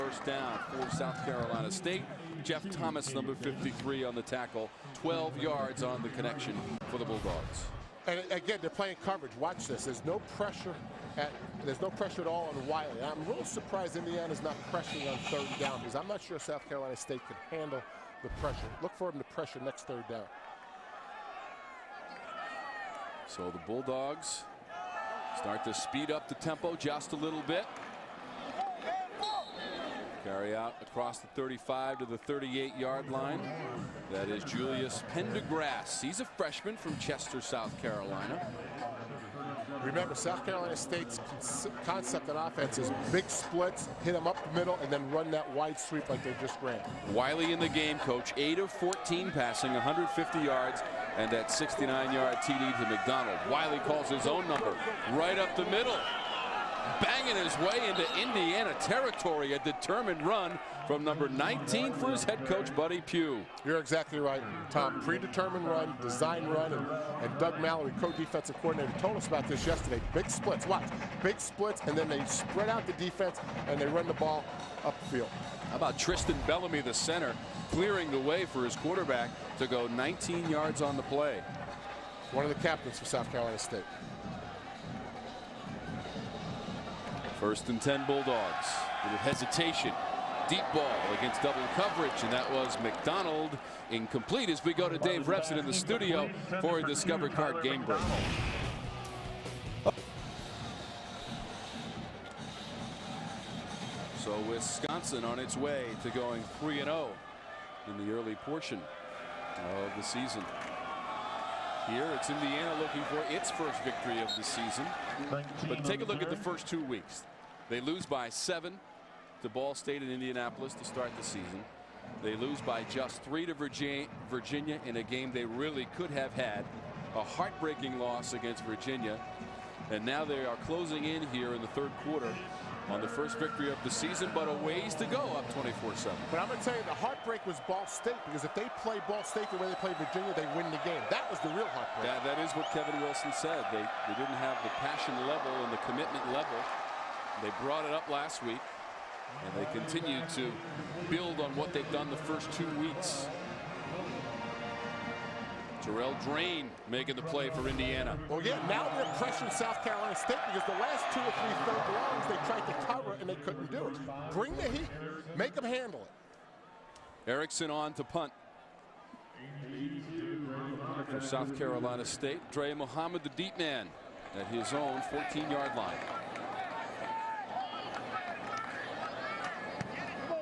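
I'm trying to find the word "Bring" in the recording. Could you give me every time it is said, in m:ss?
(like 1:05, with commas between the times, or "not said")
2:44.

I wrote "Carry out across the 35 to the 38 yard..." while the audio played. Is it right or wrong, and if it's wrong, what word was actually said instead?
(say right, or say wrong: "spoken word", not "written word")
right.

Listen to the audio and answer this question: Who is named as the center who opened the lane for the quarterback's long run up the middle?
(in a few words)
Tristan Bellamy.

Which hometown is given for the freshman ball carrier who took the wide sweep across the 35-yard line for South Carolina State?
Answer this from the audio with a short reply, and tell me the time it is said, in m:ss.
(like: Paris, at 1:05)
Chester, South Carolina, at 0:36.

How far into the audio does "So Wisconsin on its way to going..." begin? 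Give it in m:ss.
1:44.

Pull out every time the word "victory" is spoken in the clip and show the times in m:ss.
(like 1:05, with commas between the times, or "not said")
1:53, 2:13.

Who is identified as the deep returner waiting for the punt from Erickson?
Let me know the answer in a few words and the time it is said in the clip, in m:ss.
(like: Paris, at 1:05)
Dre Muhammad, at 2:52.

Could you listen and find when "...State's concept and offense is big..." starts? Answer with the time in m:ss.
0:40.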